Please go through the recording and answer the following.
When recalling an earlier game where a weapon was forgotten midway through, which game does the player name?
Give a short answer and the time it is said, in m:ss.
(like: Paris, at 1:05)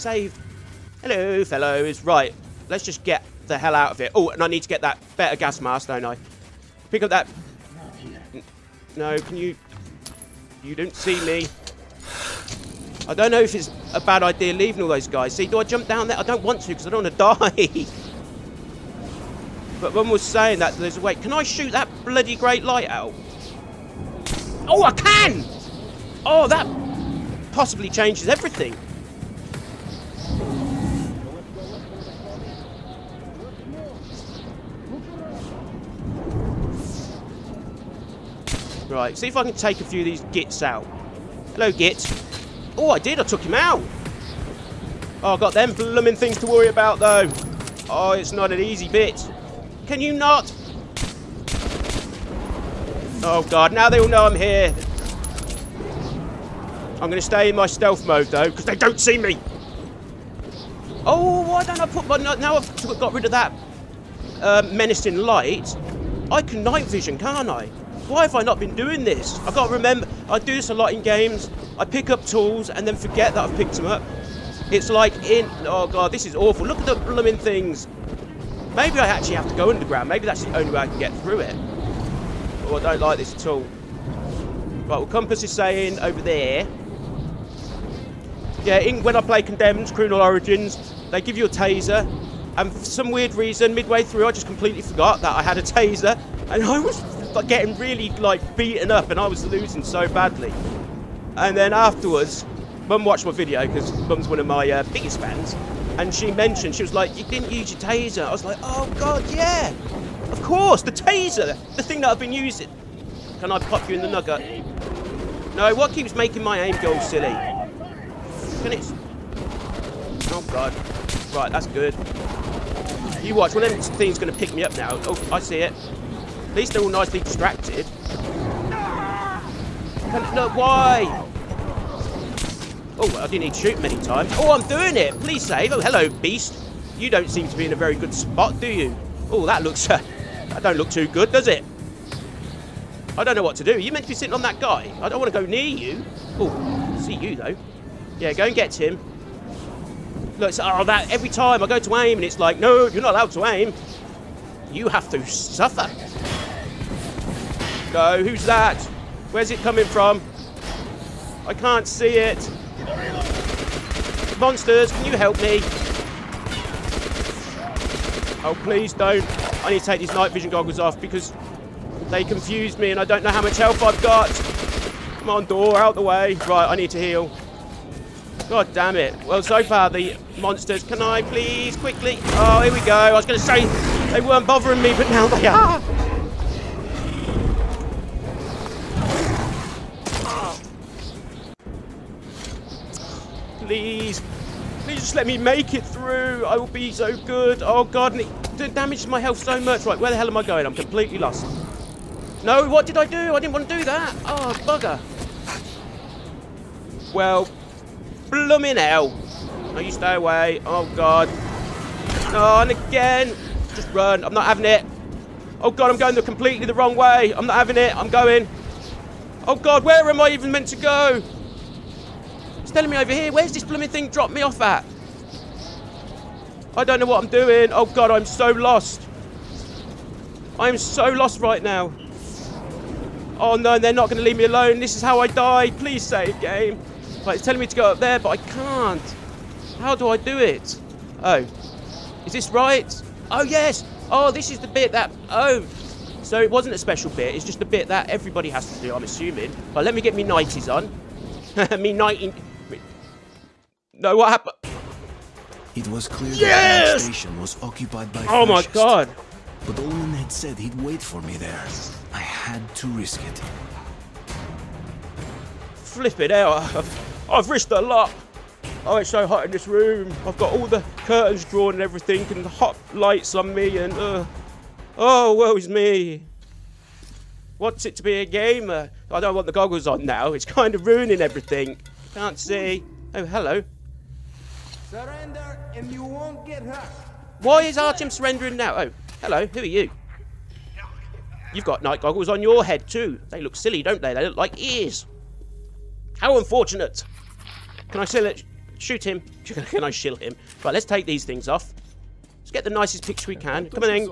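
Condemned: Criminal Origins, at 1:29.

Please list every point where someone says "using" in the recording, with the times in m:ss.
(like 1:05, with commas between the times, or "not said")
1:52.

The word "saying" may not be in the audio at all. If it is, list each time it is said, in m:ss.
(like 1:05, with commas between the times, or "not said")
0:20, 1:25.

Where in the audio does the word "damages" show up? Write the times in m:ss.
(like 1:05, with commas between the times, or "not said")
3:18.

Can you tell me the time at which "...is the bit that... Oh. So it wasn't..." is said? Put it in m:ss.
4:04.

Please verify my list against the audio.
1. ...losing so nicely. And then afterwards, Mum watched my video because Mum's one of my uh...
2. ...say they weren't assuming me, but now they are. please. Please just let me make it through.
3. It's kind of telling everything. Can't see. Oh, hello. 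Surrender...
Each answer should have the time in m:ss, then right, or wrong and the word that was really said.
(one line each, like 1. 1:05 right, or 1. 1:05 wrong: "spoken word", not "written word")
1. 1:39 wrong: "badly", not "nicely"
2. 3:03 wrong: "bothering", not "assuming"
3. 4:40 wrong: "ruining", not "telling".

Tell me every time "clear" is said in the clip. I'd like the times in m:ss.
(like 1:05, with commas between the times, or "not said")
4:16.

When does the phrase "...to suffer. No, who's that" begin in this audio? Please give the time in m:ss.
2:35.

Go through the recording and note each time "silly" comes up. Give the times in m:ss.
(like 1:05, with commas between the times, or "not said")
1:56, 4:53.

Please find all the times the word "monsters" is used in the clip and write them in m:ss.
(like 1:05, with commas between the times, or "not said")
2:44, 3:00.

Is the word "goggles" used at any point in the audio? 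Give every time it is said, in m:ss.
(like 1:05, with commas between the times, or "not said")
2:50, 4:39, 4:52.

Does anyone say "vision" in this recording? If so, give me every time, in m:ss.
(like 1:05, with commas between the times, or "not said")
1:06, 2:50.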